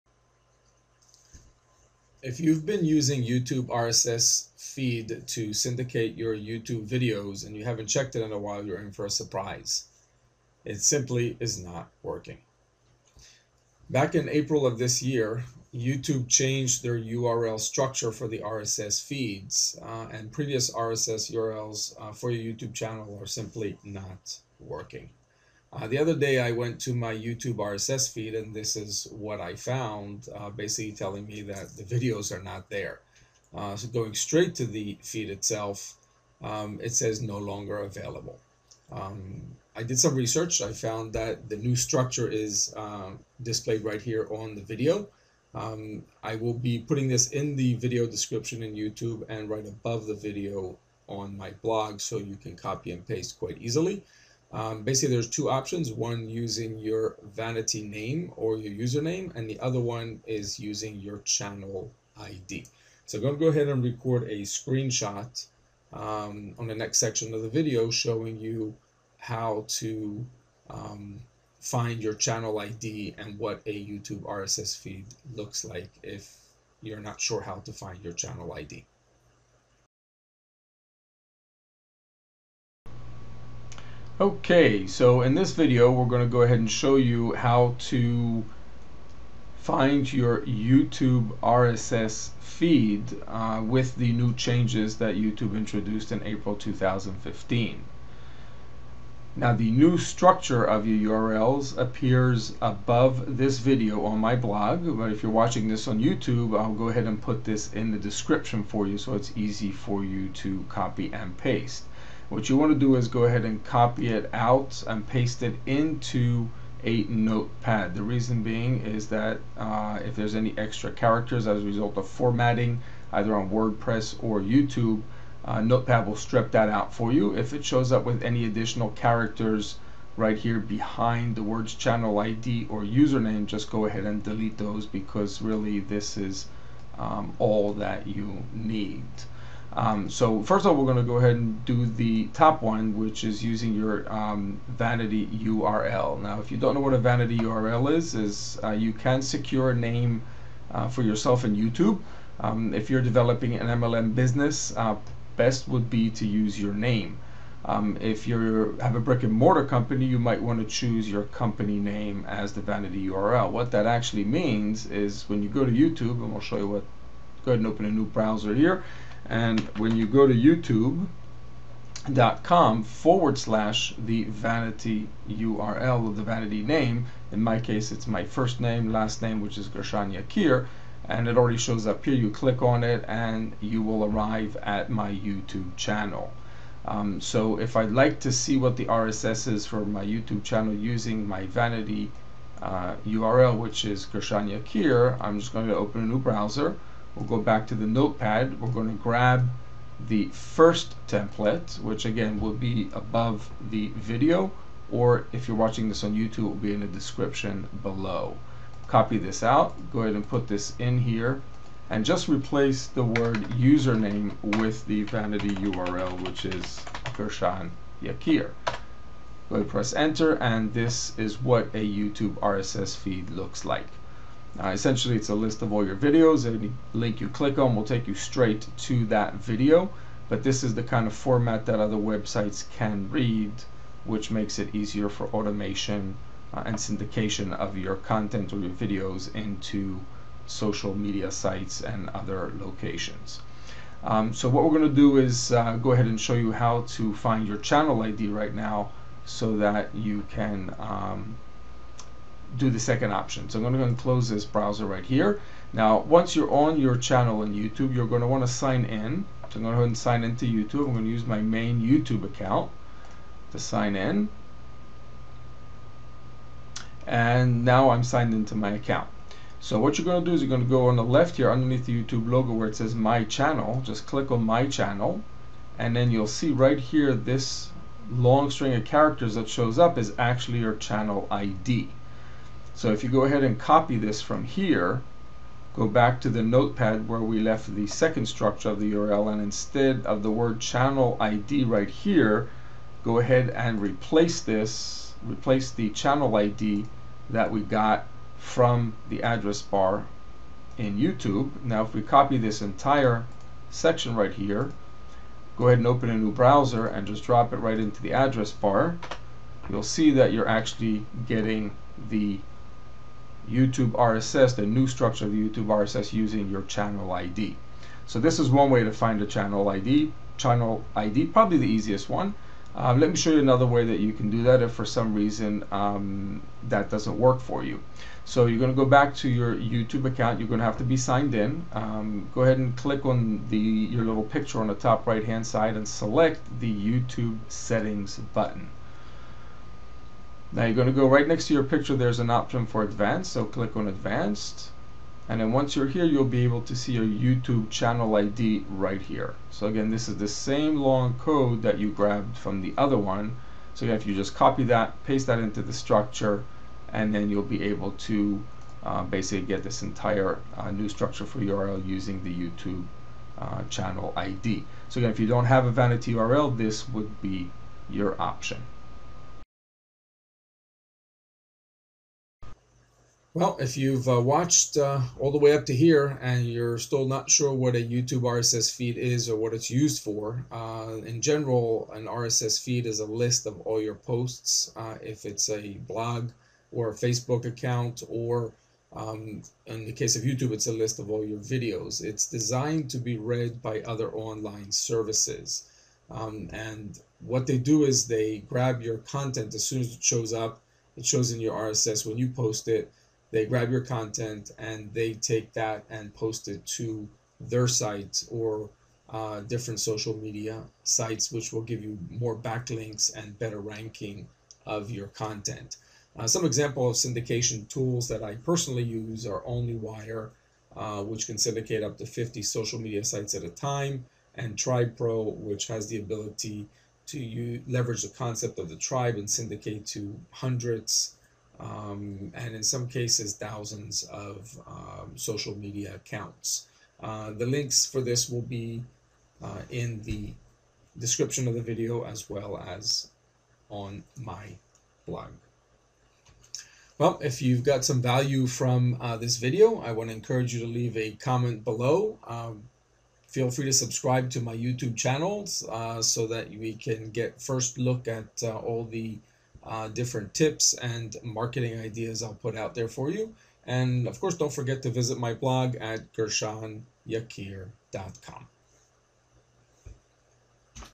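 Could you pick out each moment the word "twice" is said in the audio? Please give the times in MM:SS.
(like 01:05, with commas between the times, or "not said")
not said.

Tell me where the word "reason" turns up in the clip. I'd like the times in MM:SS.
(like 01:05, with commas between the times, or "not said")
01:58, 05:25.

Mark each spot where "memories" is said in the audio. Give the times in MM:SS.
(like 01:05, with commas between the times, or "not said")
not said.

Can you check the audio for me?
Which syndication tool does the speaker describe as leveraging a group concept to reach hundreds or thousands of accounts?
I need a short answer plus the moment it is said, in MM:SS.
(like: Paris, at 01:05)
Tribe Pro, at 07:04.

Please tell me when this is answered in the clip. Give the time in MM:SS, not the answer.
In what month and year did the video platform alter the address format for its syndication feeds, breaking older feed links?
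01:36.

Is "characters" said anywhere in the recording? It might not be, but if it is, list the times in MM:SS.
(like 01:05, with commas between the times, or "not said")
02:00, 02:08, 04:38.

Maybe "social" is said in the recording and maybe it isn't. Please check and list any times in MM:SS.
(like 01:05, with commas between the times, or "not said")
04:00, 06:49, 07:02, 07:15.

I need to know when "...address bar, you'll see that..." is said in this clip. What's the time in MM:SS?
05:08.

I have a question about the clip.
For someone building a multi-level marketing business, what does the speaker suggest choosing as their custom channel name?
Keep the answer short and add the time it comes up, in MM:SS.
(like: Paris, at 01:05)
your name, at 02:36.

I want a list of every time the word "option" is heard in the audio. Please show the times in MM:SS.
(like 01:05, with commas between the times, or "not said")
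00:55, 04:13, 05:42, 06:08.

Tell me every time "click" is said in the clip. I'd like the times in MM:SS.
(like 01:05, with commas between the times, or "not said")
03:02, 03:47, 04:34, 05:32, 05:43.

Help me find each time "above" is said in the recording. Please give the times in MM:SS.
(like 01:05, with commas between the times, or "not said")
00:49, 01:42, 03:22.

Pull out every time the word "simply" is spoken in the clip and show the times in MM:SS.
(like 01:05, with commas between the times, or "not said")
00:10, 00:23.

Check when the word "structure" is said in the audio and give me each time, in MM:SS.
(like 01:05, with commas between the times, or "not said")
00:17, 00:41, 01:39, 04:48, 05:14, 05:55, 06:00.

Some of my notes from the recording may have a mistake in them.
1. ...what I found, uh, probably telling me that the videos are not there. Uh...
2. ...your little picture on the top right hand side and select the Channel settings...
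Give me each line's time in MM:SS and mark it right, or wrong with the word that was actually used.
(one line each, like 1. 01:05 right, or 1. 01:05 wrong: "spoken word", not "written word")
1. 00:29 wrong: "basically", not "probably"
2. 05:33 wrong: "YouTube", not "Channel".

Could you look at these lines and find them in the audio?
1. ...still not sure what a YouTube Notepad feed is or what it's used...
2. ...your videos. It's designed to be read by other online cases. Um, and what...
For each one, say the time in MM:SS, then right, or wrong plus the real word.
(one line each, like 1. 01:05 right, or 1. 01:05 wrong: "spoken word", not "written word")
1. 06:16 wrong: "RSS", not "Notepad"
2. 06:31 wrong: "services", not "cases".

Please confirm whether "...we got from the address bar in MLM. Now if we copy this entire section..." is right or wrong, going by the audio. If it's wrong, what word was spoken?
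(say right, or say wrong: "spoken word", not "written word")
wrong: "YouTube", not "MLM".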